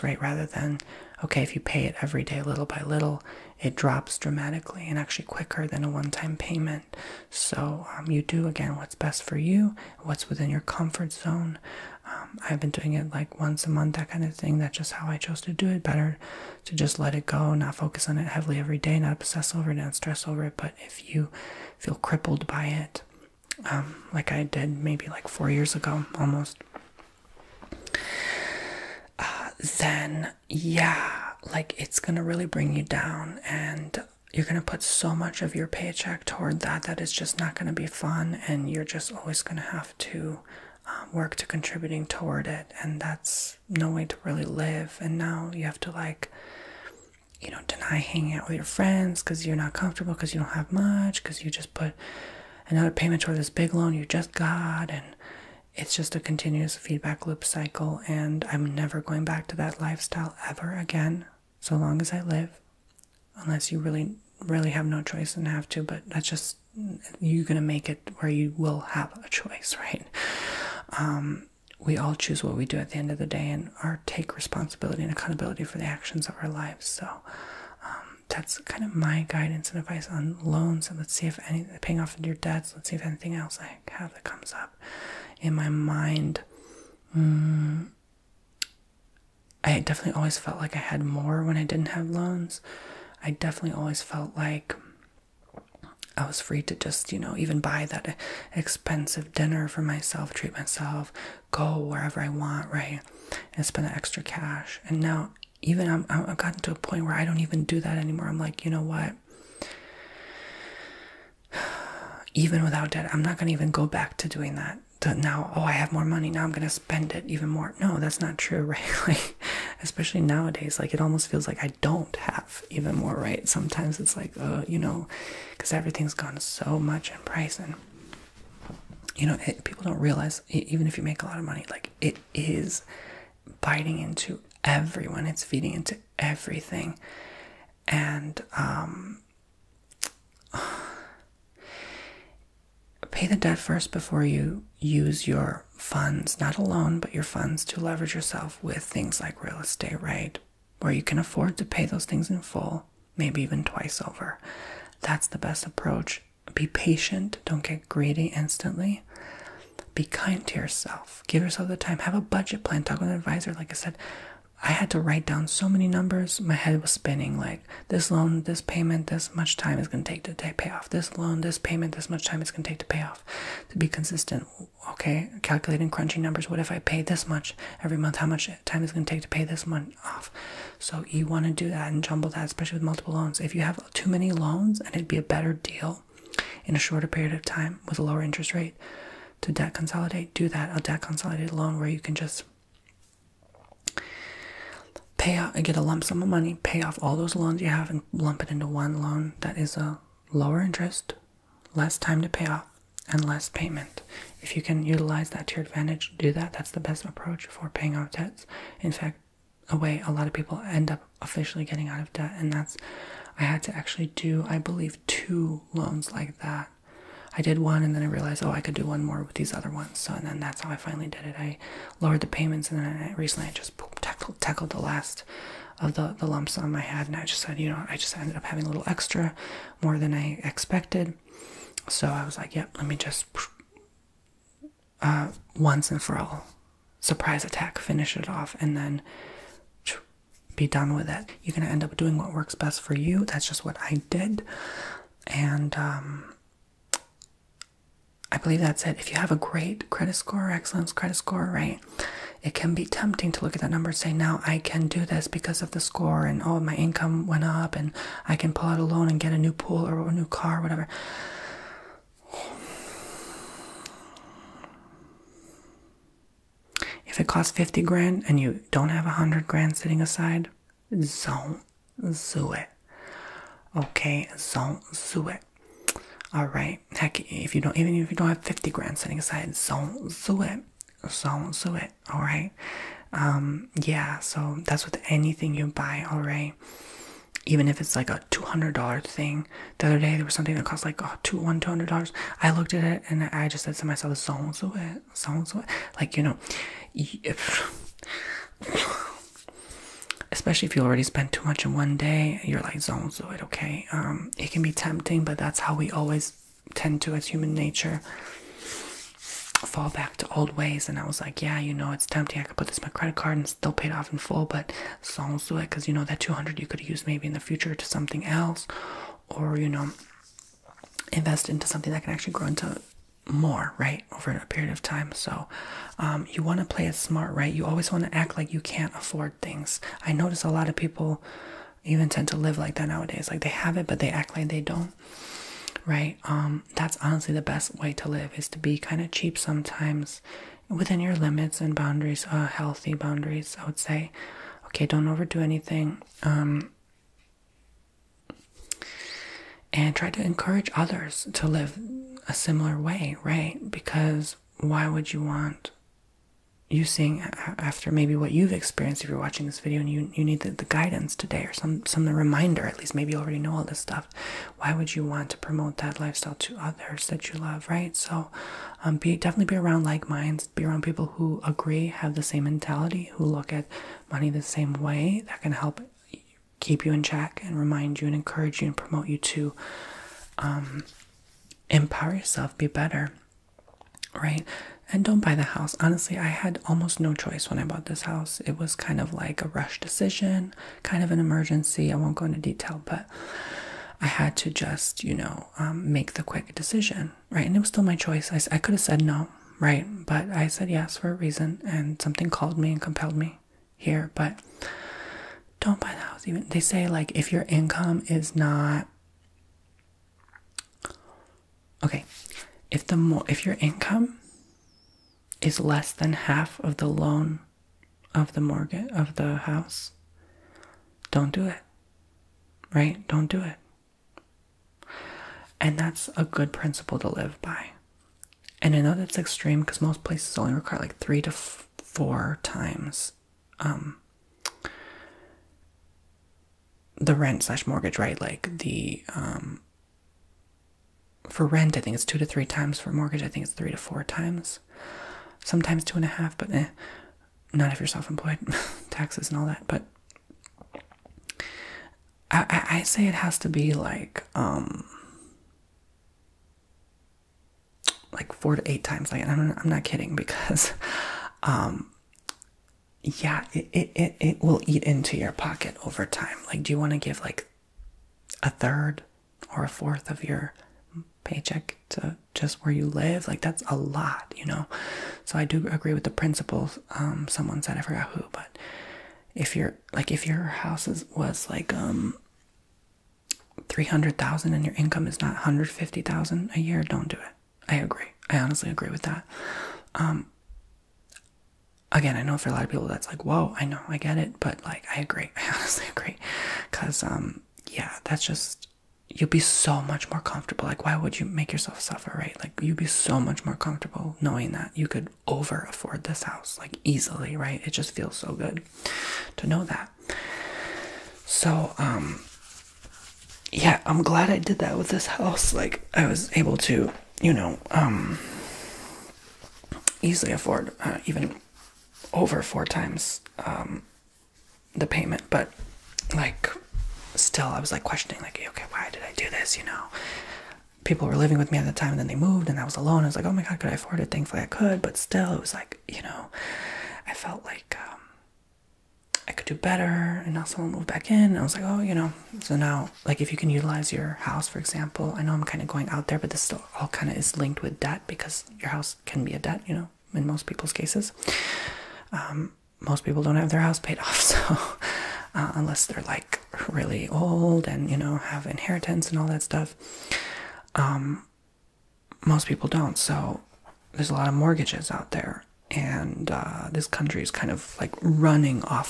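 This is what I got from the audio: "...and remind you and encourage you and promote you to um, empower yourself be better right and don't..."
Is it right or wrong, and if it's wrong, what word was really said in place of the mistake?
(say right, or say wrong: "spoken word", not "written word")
right.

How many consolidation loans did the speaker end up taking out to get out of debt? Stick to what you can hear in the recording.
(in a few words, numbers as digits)
2.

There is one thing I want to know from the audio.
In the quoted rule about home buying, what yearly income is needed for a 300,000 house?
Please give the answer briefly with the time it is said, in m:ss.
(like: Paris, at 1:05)
150,000, at 8:05.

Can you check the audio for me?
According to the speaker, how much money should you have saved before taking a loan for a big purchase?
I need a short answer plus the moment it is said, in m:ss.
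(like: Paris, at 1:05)
100 grand, at 4:29.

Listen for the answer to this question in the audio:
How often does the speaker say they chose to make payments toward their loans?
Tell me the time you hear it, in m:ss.
0:13.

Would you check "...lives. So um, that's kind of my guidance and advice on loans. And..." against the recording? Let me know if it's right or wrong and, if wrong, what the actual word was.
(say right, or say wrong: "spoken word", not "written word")
right.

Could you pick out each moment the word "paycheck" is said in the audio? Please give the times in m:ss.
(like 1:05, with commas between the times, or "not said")
0:35, 7:51.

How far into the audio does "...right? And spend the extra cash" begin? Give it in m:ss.
1:42.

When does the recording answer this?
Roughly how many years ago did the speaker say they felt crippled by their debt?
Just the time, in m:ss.
0:25.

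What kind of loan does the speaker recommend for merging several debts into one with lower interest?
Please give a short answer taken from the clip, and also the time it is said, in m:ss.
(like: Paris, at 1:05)
Debt consolidated loan, at 3:10.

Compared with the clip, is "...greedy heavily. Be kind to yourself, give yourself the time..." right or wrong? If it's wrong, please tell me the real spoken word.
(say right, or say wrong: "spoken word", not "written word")
wrong: "instantly", not "heavily".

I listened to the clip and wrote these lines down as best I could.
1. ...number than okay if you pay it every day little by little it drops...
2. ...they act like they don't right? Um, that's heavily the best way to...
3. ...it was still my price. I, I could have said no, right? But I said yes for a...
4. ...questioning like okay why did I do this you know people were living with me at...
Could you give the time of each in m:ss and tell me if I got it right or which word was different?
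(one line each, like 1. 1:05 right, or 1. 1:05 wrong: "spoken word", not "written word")
1. 0:00 wrong: "rather", not "number"
2. 5:33 wrong: "honestly", not "heavily"
3. 6:37 wrong: "choice", not "price"
4. 8:47 right.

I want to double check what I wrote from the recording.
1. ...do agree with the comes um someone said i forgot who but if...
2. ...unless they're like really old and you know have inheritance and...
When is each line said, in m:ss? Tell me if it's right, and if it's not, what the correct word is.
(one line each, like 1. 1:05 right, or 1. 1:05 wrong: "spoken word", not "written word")
1. 7:55 wrong: "principles", not "comes"
2. 9:15 right.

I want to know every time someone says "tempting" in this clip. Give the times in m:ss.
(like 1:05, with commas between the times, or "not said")
4:12, 5:04, 5:12.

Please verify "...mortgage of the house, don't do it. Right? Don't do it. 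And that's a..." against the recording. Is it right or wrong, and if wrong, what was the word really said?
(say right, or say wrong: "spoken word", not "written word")
right.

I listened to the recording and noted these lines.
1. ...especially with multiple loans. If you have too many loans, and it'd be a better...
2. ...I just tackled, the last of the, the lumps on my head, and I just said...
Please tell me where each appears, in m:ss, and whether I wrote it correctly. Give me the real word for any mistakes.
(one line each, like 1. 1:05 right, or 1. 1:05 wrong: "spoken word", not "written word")
1. 3:02 right
2. 3:43 right.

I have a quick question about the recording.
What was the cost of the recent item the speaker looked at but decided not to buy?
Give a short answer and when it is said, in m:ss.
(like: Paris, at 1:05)
$200, at 4:51.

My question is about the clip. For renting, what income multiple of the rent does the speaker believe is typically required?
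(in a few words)
2 to 3 times.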